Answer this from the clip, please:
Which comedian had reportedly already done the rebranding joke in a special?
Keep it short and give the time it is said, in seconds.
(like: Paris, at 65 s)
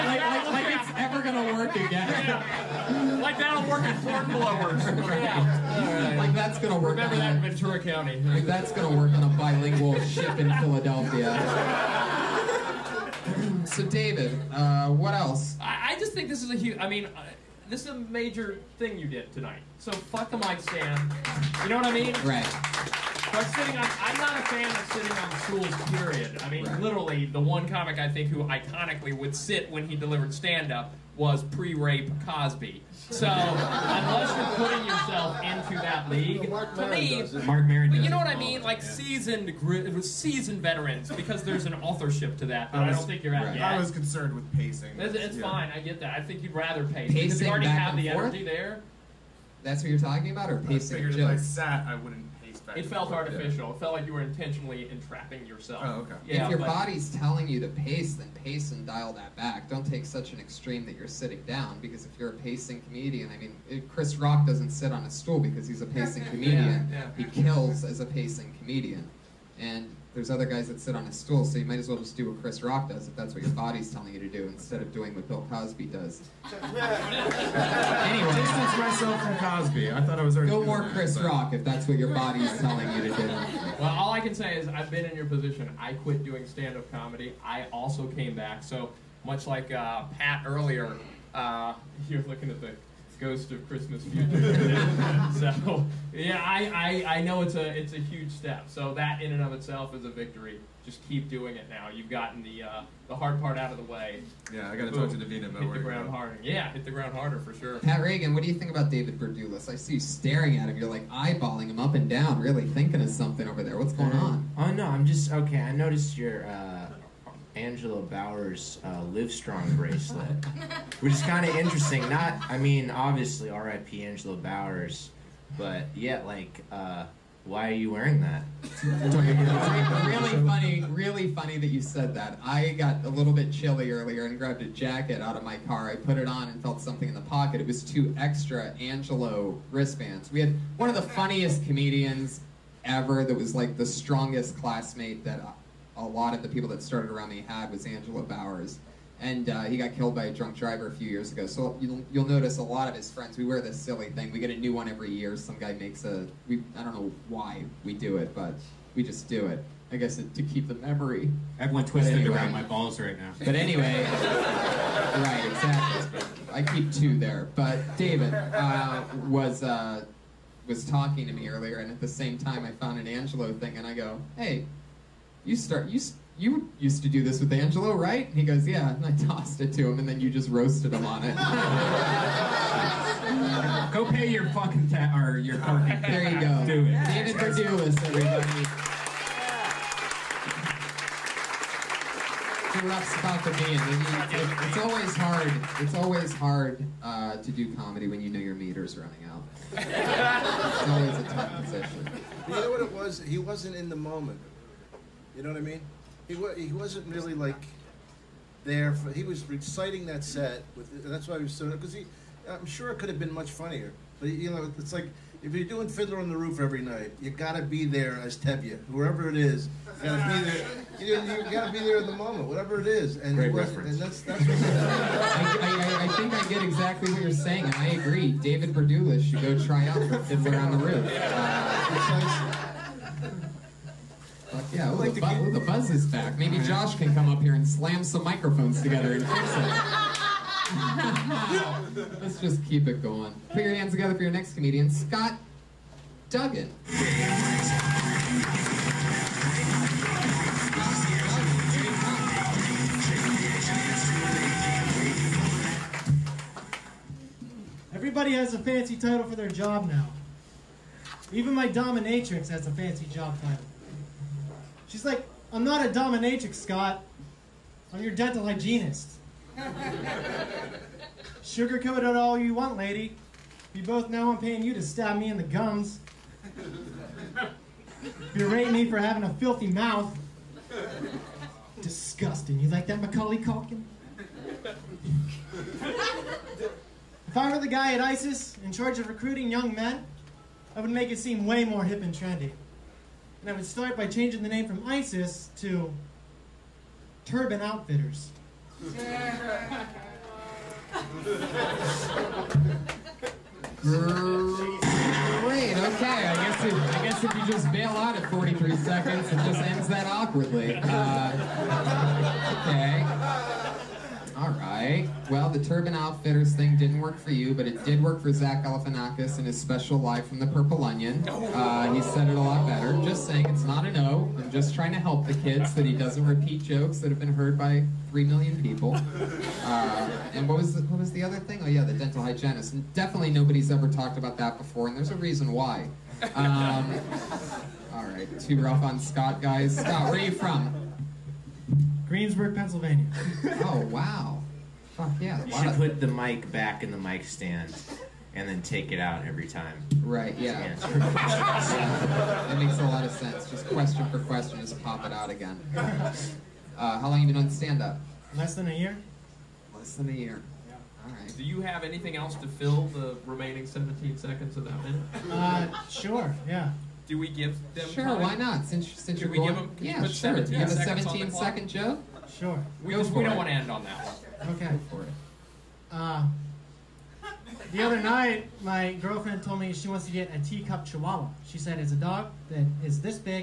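Zach Galifianakis, at 318 s.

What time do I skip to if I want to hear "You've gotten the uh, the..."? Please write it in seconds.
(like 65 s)
101 s.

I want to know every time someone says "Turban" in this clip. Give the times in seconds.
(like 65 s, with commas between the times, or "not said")
297 s, 315 s.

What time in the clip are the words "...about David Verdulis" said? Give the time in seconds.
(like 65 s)
108 s.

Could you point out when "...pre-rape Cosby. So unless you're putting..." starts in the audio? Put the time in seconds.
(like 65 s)
31 s.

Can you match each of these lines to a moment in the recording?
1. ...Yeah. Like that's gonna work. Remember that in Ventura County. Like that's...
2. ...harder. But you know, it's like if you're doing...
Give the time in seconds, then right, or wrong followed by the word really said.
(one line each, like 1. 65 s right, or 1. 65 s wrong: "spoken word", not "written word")
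1. 5 s right
2. 213 s wrong: "funnier", not "harder".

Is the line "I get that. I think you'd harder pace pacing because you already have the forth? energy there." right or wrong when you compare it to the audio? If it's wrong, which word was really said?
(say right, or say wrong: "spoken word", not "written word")
wrong: "rather", not "harder".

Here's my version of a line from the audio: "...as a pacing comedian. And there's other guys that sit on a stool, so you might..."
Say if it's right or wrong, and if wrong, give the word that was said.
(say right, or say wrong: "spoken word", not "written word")
right.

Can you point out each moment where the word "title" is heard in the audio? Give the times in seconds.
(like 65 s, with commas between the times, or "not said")
258 s, 263 s.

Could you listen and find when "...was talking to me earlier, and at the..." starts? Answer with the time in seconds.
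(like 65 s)
170 s.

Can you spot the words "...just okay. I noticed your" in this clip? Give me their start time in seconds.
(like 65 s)
115 s.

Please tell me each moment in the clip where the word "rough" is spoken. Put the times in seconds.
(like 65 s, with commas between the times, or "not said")
192 s, 338 s.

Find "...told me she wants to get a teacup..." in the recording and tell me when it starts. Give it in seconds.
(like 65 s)
379 s.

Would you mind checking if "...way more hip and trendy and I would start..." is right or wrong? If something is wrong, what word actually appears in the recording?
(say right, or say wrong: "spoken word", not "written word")
right.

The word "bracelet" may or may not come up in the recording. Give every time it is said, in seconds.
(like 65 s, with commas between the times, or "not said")
119 s.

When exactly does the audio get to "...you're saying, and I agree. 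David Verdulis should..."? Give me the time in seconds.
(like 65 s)
227 s.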